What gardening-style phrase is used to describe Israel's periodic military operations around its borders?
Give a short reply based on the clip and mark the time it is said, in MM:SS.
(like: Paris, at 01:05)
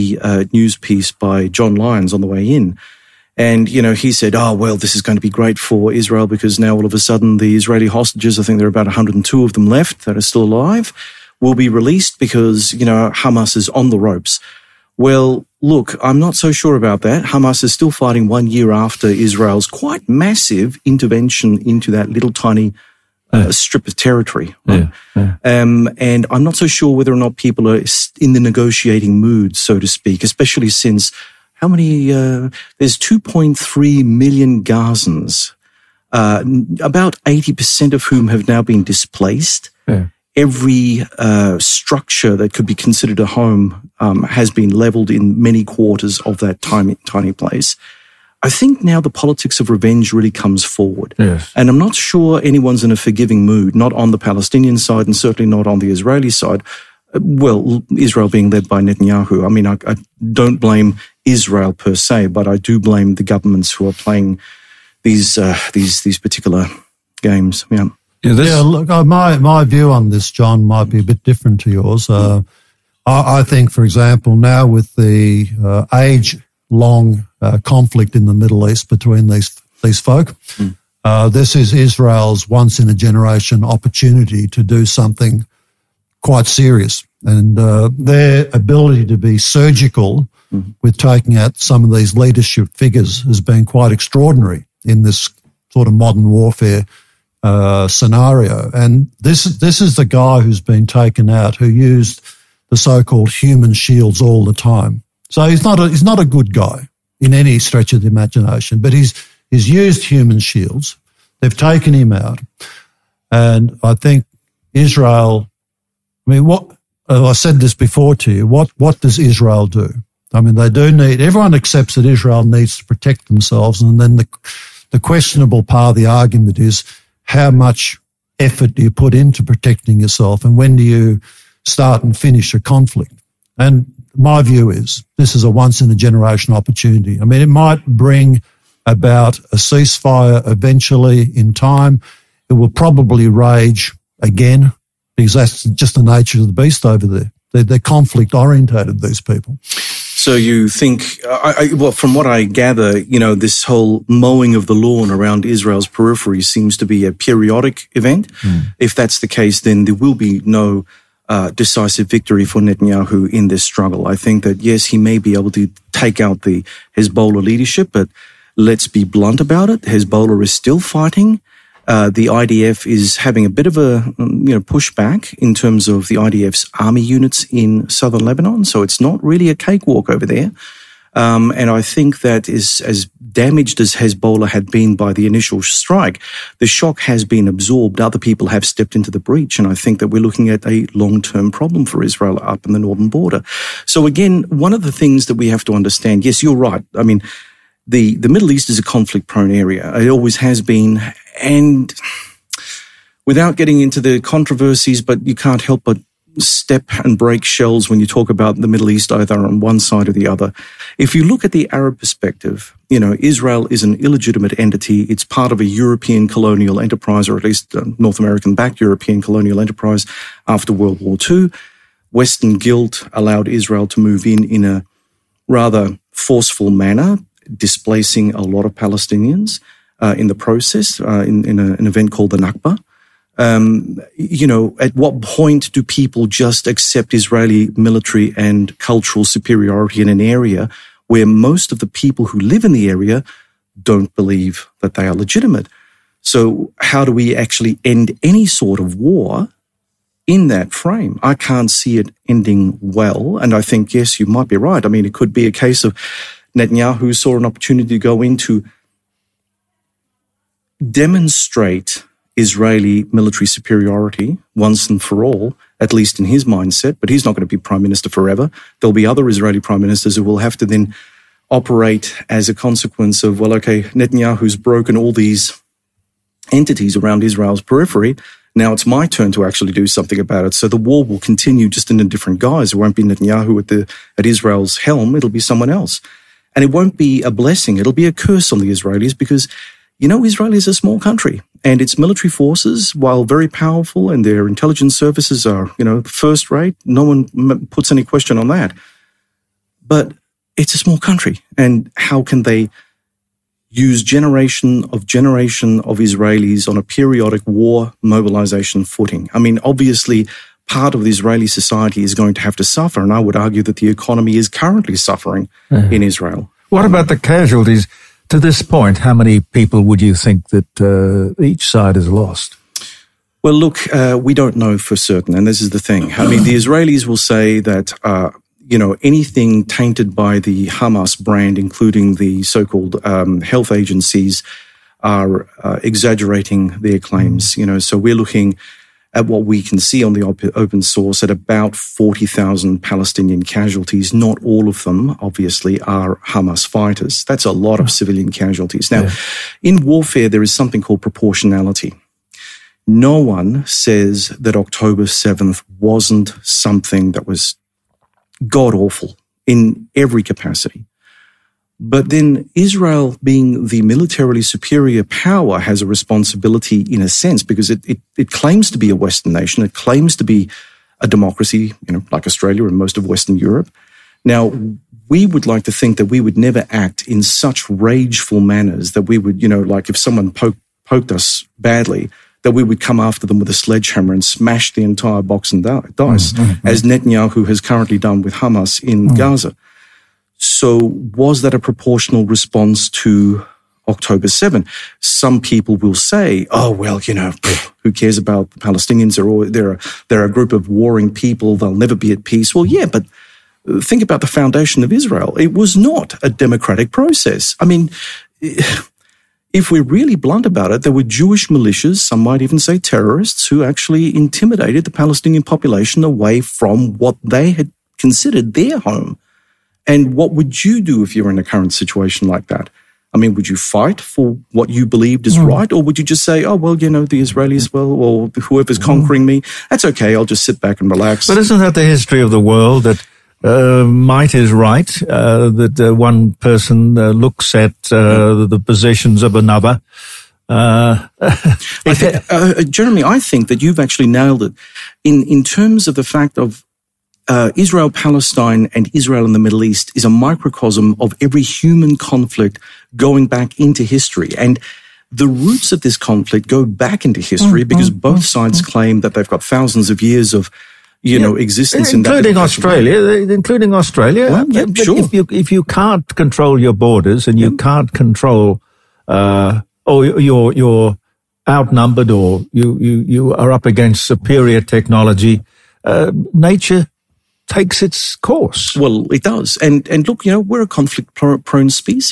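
mowing of the lawn, at 02:34.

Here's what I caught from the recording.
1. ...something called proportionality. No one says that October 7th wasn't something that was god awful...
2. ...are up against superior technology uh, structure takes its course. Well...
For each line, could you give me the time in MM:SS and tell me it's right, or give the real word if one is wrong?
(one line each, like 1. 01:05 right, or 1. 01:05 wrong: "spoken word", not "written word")
1. 05:50 right
2. 07:53 wrong: "nature", not "structure".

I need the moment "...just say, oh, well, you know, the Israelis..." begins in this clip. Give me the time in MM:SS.
07:06.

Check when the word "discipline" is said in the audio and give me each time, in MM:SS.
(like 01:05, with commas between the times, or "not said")
not said.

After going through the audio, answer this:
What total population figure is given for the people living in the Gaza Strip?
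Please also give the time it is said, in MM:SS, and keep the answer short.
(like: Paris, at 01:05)
2.3 million, at 00:32.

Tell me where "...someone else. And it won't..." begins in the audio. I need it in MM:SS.
04:45.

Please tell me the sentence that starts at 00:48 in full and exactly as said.
I think now the politics of revenge really comes forward.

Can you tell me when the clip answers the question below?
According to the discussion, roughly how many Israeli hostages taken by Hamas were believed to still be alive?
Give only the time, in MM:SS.
00:08.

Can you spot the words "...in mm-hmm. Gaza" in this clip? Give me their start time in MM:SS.
06:28.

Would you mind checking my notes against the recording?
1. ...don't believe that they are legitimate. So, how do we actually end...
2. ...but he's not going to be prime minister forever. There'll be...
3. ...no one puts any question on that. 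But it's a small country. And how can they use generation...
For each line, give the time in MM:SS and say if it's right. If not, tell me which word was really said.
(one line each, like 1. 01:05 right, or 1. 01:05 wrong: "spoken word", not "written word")
1. 04:03 right
2. 04:26 right
3. 04:56 right.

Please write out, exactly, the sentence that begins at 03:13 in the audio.
So, again, one of the things that we have to understand yes, you're right.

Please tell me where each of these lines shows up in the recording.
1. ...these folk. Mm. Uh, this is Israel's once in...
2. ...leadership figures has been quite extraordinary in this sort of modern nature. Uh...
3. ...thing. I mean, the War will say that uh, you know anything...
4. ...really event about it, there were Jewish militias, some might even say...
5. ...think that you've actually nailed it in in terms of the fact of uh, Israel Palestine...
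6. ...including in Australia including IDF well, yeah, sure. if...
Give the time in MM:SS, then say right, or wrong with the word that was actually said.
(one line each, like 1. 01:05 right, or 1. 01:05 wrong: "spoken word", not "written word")
1. 01:19 right
2. 01:32 wrong: "warfare", not "nature"
3. 05:25 wrong: "Israelis", not "War"
4. 06:49 wrong: "blunt", not "event"
5. 07:23 right
6. 07:41 wrong: "Australia", not "IDF".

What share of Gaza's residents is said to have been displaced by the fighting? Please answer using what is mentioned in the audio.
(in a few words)
80%.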